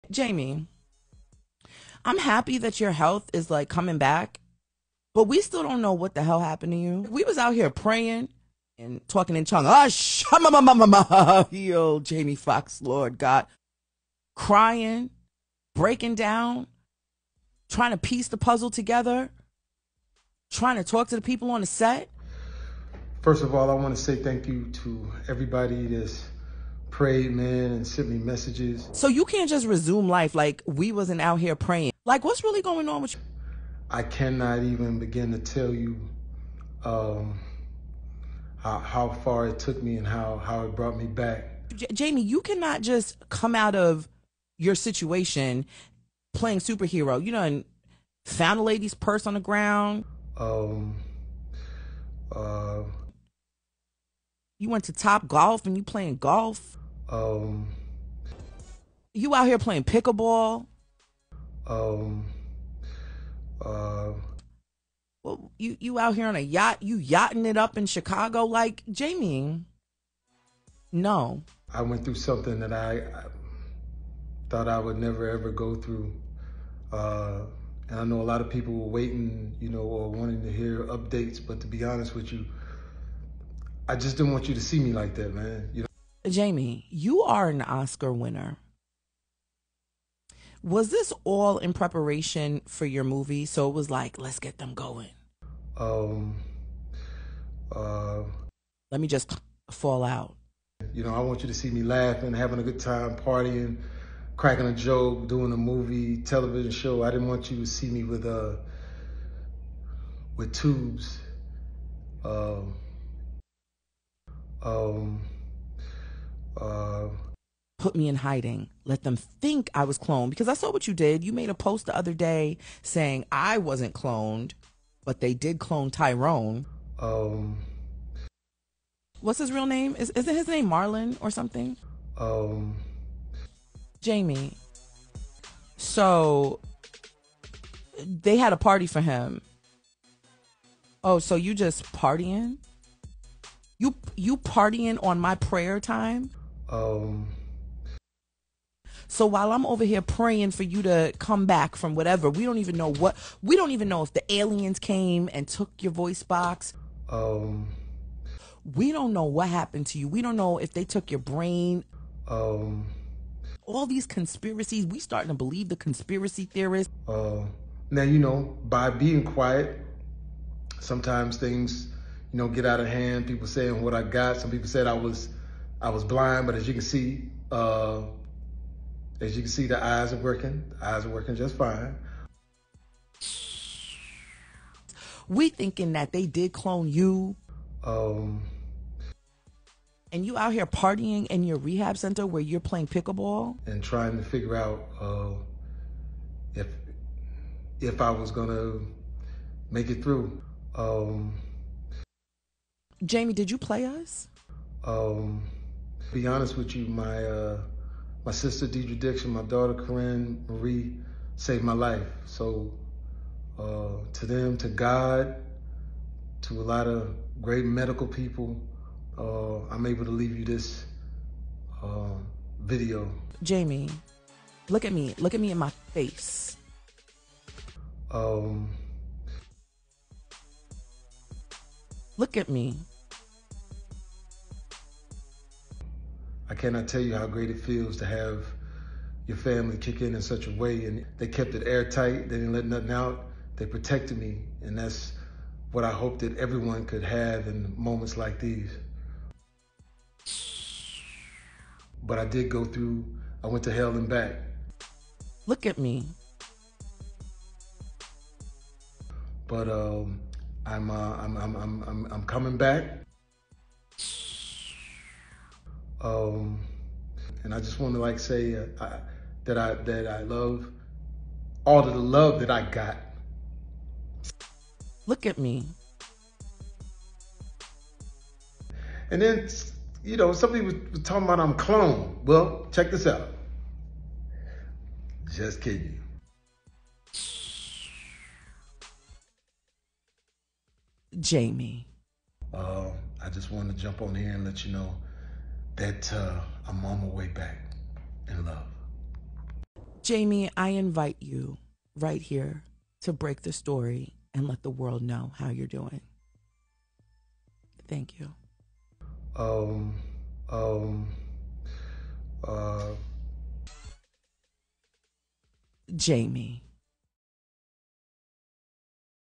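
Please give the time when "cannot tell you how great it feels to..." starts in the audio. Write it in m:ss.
3:56.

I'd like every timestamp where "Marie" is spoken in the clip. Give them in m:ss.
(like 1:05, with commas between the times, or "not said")
3:30.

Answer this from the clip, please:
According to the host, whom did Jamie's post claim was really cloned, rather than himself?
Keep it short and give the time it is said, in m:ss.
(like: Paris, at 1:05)
Tyrone, at 2:05.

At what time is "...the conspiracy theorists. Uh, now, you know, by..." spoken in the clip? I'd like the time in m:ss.
2:45.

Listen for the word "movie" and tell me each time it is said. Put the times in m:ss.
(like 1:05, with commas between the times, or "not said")
1:33, 1:45.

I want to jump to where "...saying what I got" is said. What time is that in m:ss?
2:53.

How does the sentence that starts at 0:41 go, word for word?
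J- Jamie, you cannot just come out of your situation playing superhero.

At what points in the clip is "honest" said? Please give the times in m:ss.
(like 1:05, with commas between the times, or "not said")
1:21, 3:26.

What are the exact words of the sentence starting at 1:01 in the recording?
Um, uh, well, you you out here on a yacht?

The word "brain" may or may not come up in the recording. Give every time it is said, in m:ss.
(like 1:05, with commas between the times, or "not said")
2:41.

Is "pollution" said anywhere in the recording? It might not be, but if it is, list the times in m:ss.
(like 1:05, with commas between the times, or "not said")
not said.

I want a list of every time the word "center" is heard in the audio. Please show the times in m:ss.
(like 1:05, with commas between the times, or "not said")
3:11.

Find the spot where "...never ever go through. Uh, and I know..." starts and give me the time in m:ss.
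1:14.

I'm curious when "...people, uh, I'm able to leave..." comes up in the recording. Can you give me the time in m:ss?
3:38.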